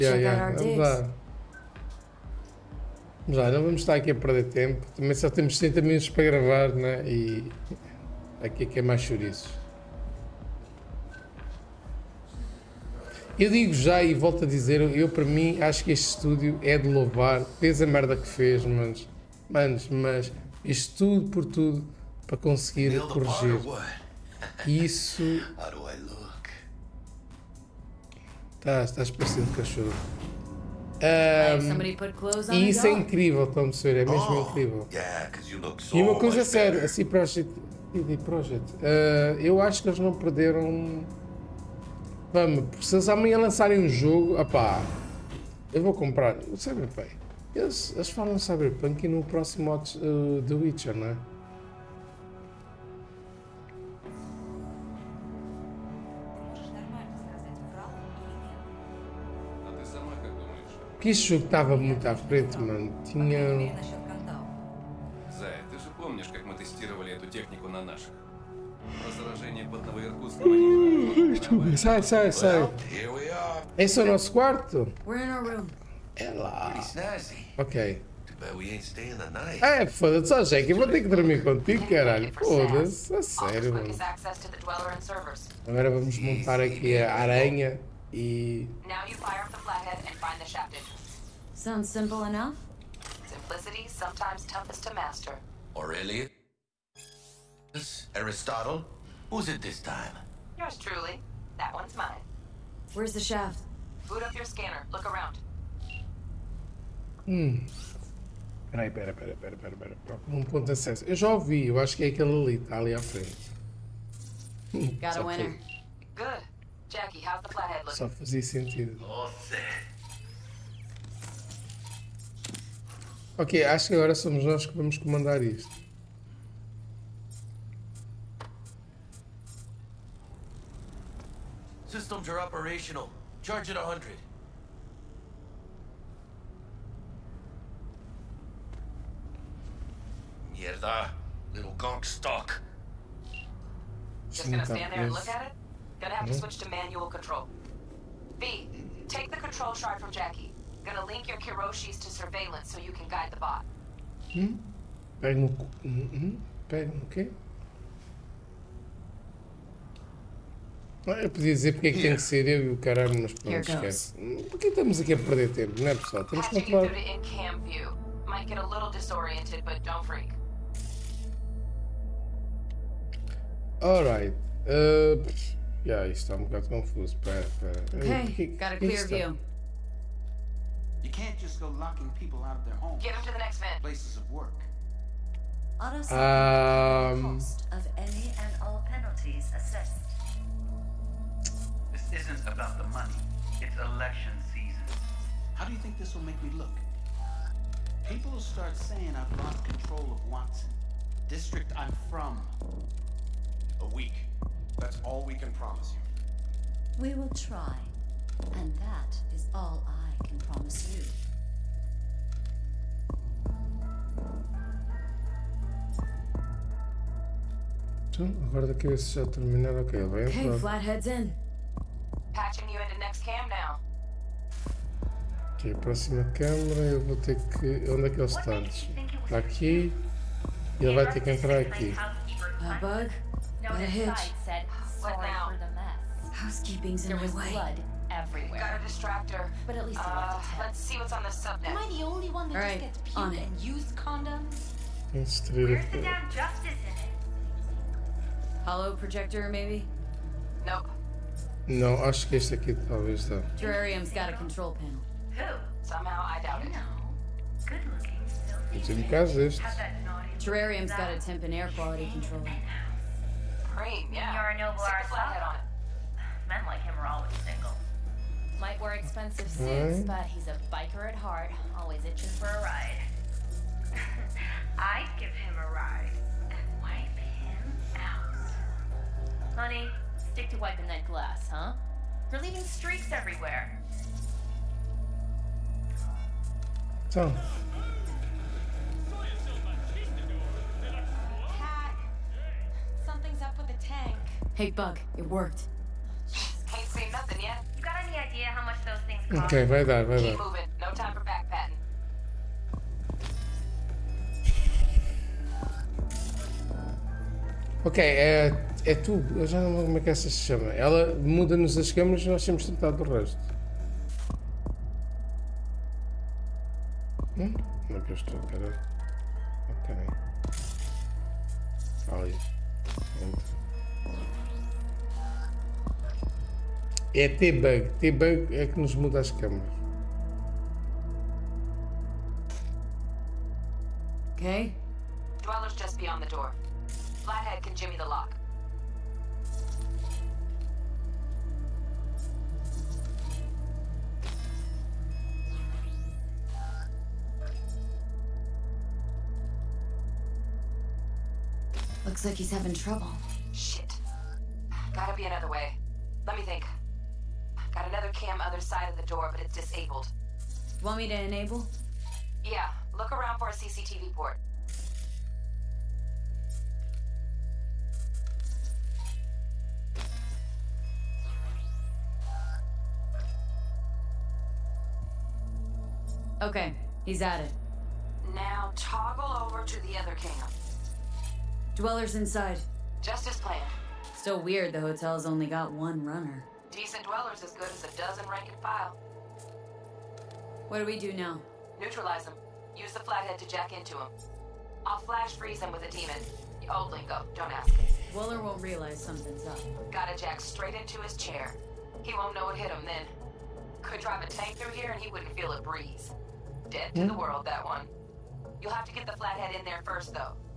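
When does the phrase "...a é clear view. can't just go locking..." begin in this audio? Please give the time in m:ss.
2:58.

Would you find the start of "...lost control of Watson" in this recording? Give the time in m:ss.
3:19.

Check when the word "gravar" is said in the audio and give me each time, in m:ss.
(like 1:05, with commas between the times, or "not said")
0:06.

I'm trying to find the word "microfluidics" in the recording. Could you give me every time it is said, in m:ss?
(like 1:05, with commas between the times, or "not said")
not said.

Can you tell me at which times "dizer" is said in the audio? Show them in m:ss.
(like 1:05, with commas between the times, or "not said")
0:14, 2:41.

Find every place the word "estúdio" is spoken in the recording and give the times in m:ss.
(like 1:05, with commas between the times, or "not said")
0:16.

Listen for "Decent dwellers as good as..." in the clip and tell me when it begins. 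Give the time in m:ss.
6:26.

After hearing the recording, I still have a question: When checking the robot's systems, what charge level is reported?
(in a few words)
100.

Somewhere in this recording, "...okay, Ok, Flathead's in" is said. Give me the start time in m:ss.
3:40.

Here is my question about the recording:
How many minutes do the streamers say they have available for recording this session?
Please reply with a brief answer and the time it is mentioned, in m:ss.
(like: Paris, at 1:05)
60, at 0:05.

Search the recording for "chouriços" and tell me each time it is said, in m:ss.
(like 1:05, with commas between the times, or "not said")
0:09.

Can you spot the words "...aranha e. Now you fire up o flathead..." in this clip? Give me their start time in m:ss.
1:27.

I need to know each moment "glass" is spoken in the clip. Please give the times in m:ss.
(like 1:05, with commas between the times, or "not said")
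4:41.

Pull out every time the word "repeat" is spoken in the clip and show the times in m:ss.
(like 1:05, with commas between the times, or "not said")
not said.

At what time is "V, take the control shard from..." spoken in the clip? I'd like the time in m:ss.
2:28.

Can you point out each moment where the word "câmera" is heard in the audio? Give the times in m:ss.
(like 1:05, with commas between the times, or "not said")
3:46, 5:11.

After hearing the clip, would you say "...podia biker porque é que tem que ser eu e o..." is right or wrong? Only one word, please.
wrong.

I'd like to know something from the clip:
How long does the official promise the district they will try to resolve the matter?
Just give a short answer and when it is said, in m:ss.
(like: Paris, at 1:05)
A week, at 3:23.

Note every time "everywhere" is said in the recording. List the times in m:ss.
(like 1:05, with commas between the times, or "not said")
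3:58, 4:43.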